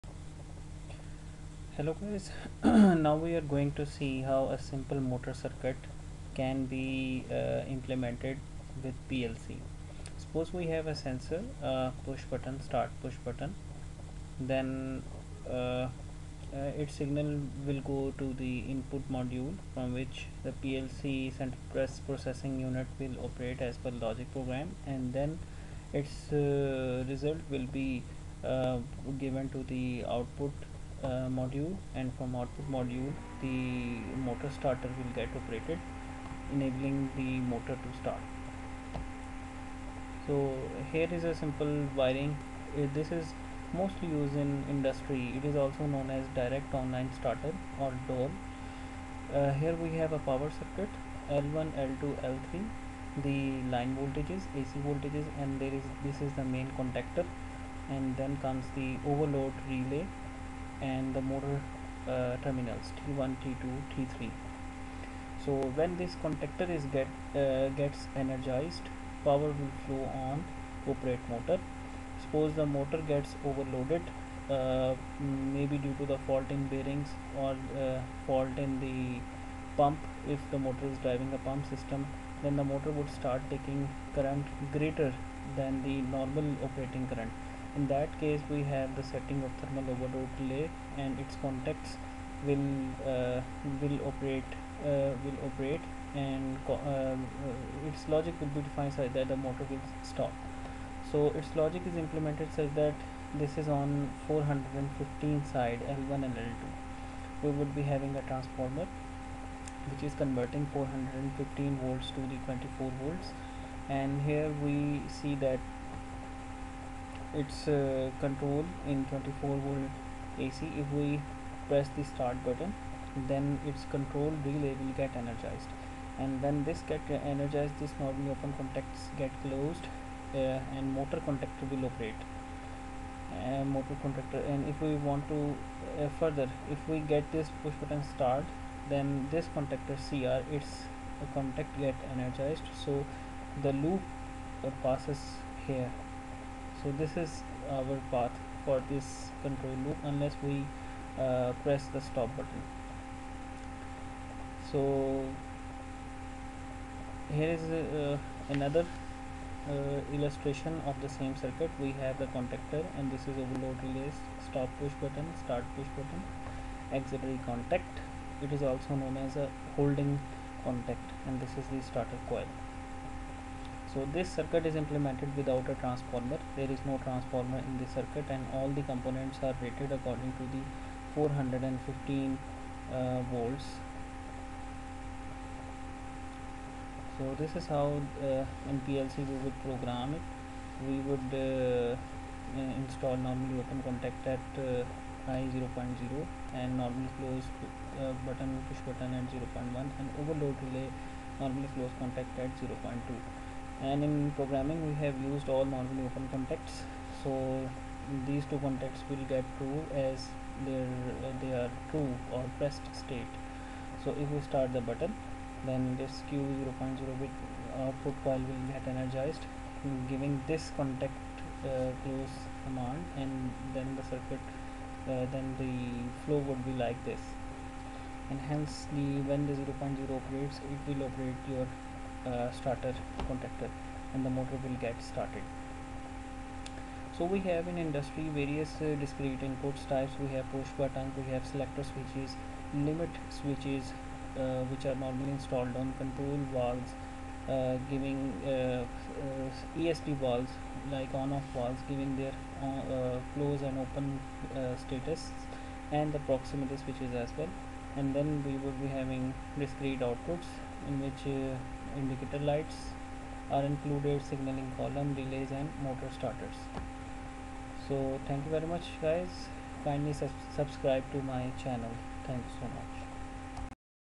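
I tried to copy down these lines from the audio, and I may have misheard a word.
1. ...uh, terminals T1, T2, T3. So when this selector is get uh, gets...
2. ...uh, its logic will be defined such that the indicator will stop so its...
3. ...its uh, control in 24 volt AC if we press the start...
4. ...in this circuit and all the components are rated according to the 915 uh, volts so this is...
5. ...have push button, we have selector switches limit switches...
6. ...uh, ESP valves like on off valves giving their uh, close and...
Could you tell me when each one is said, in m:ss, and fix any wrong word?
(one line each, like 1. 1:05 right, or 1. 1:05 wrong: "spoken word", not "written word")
1. 1:02 wrong: "contactor", not "selector"
2. 1:36 wrong: "motor", not "indicator"
3. 1:57 right
4. 2:57 wrong: "415", not "915"
5. 4:00 right
6. 4:09 right.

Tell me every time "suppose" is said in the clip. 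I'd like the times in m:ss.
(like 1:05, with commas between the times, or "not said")
0:10, 1:12.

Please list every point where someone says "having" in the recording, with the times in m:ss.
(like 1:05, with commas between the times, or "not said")
1:47, 4:18.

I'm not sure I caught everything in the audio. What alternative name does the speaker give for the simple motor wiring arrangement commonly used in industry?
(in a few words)
direct online starter.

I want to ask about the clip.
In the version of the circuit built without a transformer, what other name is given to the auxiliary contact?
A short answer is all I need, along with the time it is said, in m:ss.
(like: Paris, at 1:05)
holding contact, at 2:49.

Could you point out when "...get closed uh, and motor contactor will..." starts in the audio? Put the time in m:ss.
2:09.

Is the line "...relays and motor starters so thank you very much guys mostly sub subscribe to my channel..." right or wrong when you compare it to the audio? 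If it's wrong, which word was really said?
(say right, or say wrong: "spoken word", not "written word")
wrong: "kindly", not "mostly".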